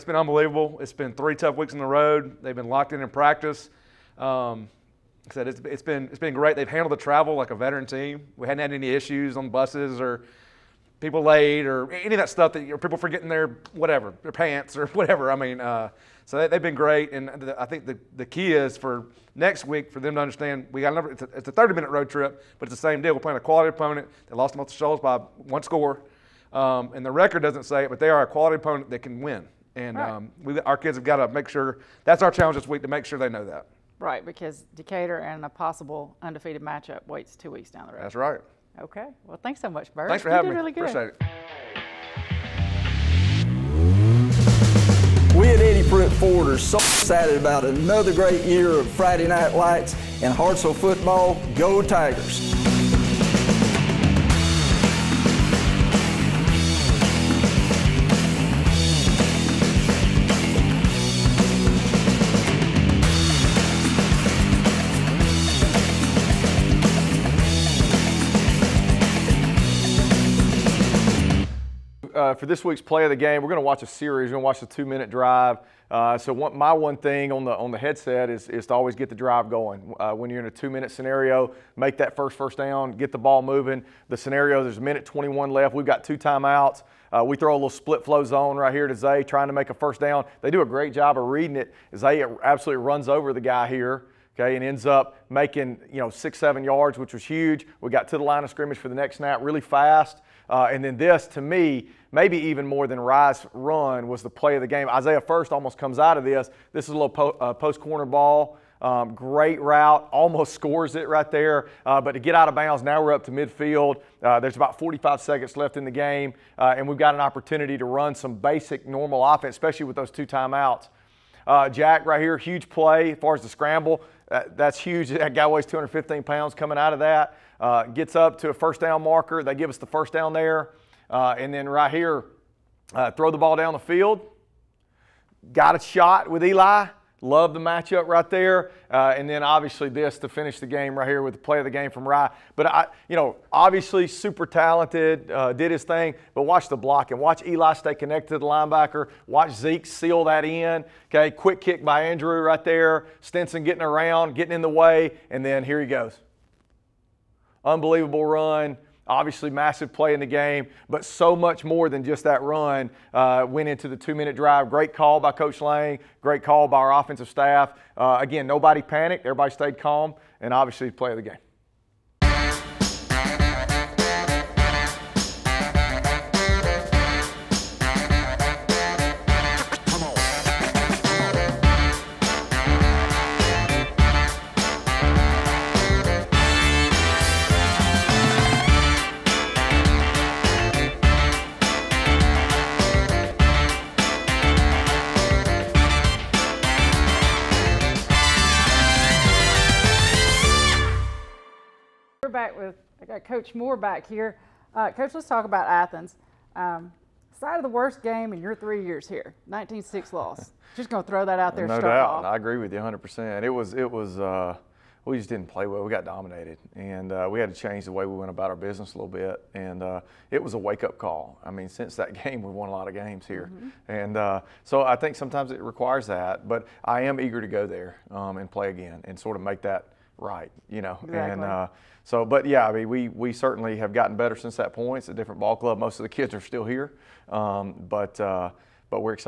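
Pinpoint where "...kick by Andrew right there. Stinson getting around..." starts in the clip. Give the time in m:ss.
2:31.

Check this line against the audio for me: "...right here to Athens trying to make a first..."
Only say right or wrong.
wrong.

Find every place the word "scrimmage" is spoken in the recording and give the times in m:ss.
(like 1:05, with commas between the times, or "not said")
1:38.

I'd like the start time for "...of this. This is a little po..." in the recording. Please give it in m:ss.
1:46.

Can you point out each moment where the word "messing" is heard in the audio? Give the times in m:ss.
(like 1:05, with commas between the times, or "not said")
not said.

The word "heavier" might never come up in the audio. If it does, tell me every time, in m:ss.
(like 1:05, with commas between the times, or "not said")
not said.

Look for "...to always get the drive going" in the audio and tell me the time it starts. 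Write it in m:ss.
1:18.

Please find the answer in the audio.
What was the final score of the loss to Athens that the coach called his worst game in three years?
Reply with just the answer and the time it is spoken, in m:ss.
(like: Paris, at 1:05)
19-6, at 3:29.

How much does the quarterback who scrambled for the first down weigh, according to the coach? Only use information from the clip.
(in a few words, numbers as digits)
215 pounds.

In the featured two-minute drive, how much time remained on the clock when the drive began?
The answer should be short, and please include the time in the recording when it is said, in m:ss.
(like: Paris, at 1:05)
1:21, at 1:24.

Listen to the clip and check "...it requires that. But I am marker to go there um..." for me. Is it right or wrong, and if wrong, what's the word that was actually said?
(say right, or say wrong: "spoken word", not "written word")
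wrong: "eager", not "marker".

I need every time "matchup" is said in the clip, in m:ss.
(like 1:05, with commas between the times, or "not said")
0:36, 2:17.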